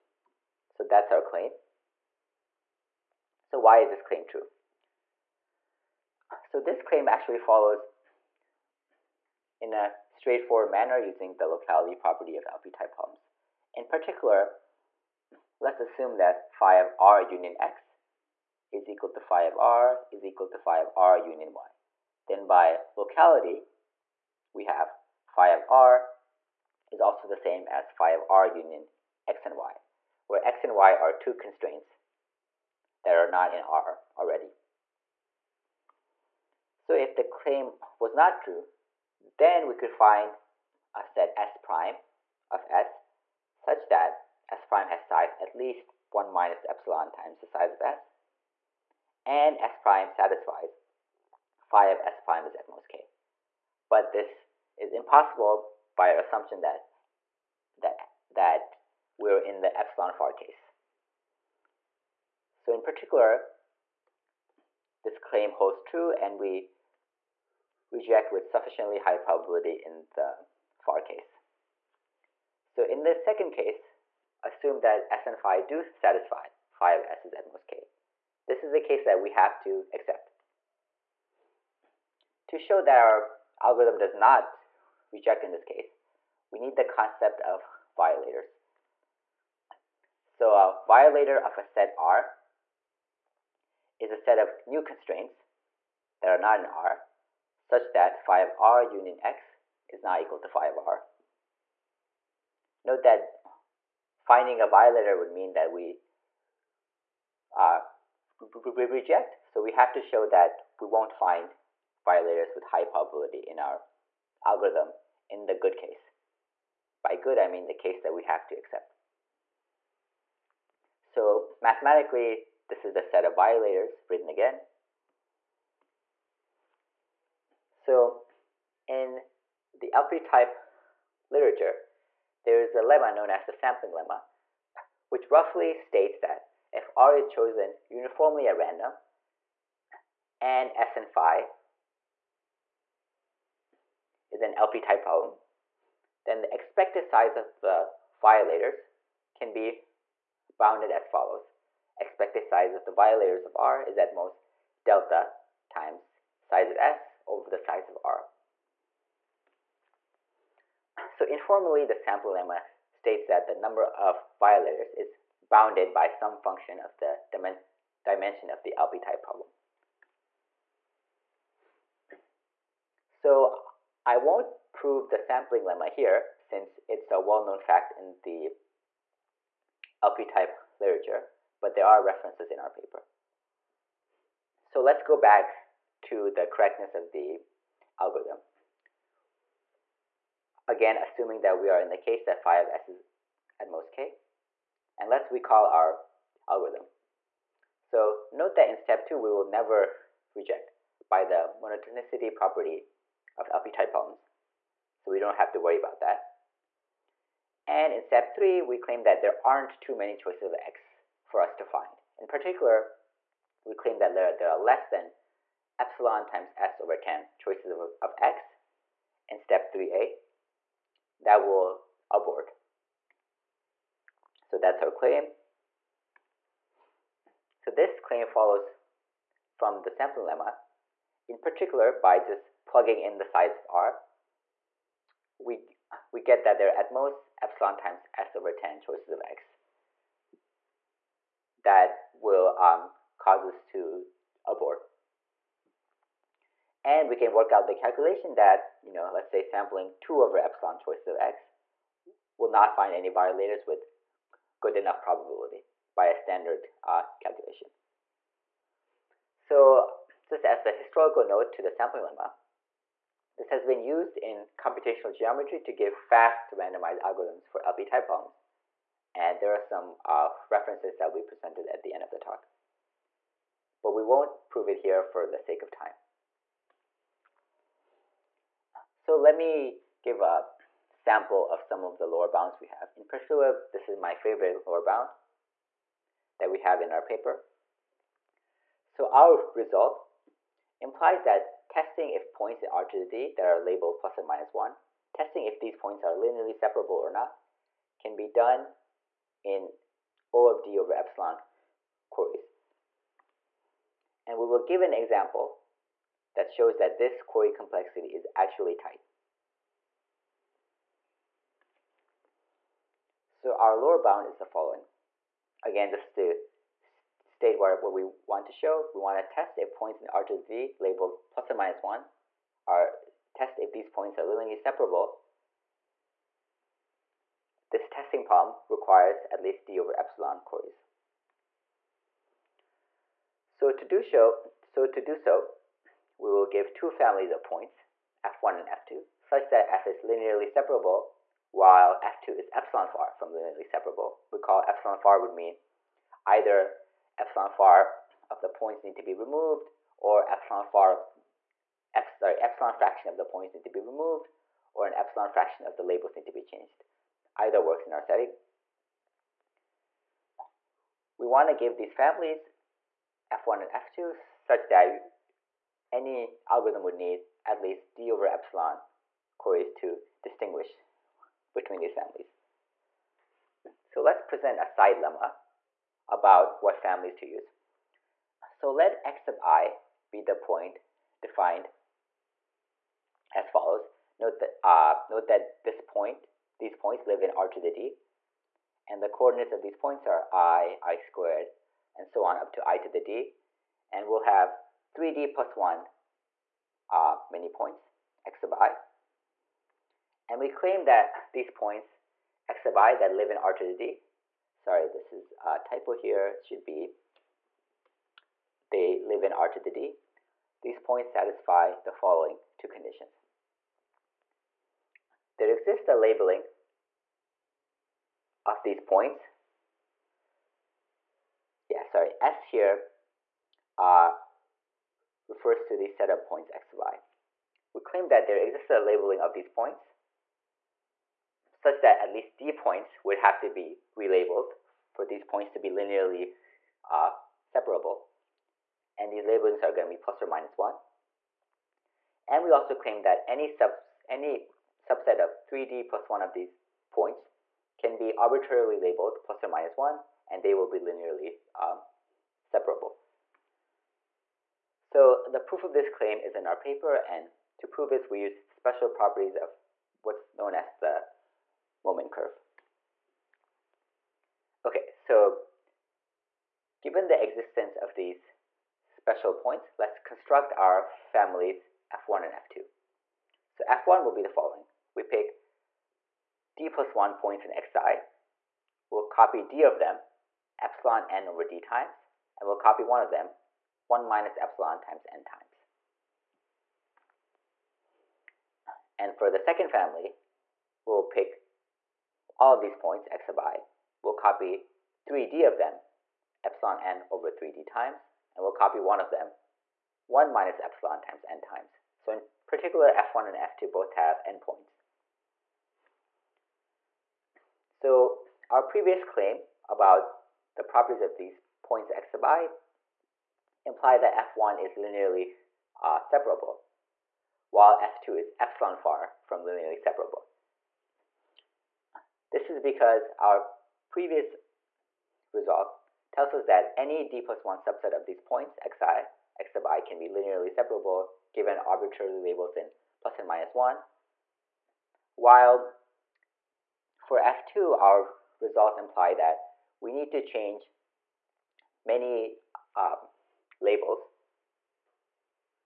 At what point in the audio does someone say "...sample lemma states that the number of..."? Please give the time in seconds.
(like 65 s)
161 s.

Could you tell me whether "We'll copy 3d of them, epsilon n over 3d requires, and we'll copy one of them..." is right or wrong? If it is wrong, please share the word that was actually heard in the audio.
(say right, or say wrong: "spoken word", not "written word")
wrong: "times", not "requires".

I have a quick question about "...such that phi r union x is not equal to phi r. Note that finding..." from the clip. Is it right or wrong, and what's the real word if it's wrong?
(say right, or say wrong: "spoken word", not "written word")
right.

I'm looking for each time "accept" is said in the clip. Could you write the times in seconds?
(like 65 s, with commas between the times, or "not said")
79 s, 118 s.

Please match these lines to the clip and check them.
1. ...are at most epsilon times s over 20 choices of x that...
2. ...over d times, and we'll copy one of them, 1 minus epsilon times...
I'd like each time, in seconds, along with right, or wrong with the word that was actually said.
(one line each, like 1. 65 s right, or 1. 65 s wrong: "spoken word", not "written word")
1. 236 s wrong: "10", not "20"
2. 481 s right.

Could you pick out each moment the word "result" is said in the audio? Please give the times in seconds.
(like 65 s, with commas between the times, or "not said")
289 s, 525 s, 538 s.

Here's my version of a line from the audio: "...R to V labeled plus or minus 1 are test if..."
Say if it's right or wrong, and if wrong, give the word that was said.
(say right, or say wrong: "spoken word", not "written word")
right.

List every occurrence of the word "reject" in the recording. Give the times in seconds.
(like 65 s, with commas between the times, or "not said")
67 s, 85 s, 108 s, 200 s.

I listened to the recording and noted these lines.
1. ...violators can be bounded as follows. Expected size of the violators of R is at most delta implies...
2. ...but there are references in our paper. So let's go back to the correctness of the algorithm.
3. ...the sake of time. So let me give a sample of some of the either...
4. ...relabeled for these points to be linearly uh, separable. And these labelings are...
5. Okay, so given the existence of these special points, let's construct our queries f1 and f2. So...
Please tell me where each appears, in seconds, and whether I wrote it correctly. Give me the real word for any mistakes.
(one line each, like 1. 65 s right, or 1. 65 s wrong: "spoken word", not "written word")
1. 148 s wrong: "times", not "implies"
2. 181 s right
3. 275 s wrong: "lower", not "either"
4. 433 s right
5. 464 s wrong: "families", not "queries".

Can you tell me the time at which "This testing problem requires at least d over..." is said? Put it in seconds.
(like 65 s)
327 s.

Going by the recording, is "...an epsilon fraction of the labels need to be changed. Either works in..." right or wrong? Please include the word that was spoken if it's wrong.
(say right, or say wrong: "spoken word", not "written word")
right.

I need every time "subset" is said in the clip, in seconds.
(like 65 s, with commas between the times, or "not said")
444 s, 527 s.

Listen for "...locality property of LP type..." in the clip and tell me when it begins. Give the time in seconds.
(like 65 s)
11 s.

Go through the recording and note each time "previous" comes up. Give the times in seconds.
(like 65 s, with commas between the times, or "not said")
508 s, 523 s.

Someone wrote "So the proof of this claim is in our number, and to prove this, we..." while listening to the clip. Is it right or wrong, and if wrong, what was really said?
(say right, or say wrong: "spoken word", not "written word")
wrong: "paper", not "number".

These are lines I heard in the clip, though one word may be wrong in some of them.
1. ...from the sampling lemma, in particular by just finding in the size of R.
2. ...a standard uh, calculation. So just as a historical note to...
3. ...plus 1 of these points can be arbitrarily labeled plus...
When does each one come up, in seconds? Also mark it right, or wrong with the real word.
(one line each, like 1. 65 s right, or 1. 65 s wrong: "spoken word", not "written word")
1. 229 s wrong: "plugging", not "finding"
2. 256 s right
3. 445 s right.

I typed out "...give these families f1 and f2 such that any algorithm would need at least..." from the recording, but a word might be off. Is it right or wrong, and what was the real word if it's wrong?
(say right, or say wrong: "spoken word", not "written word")
right.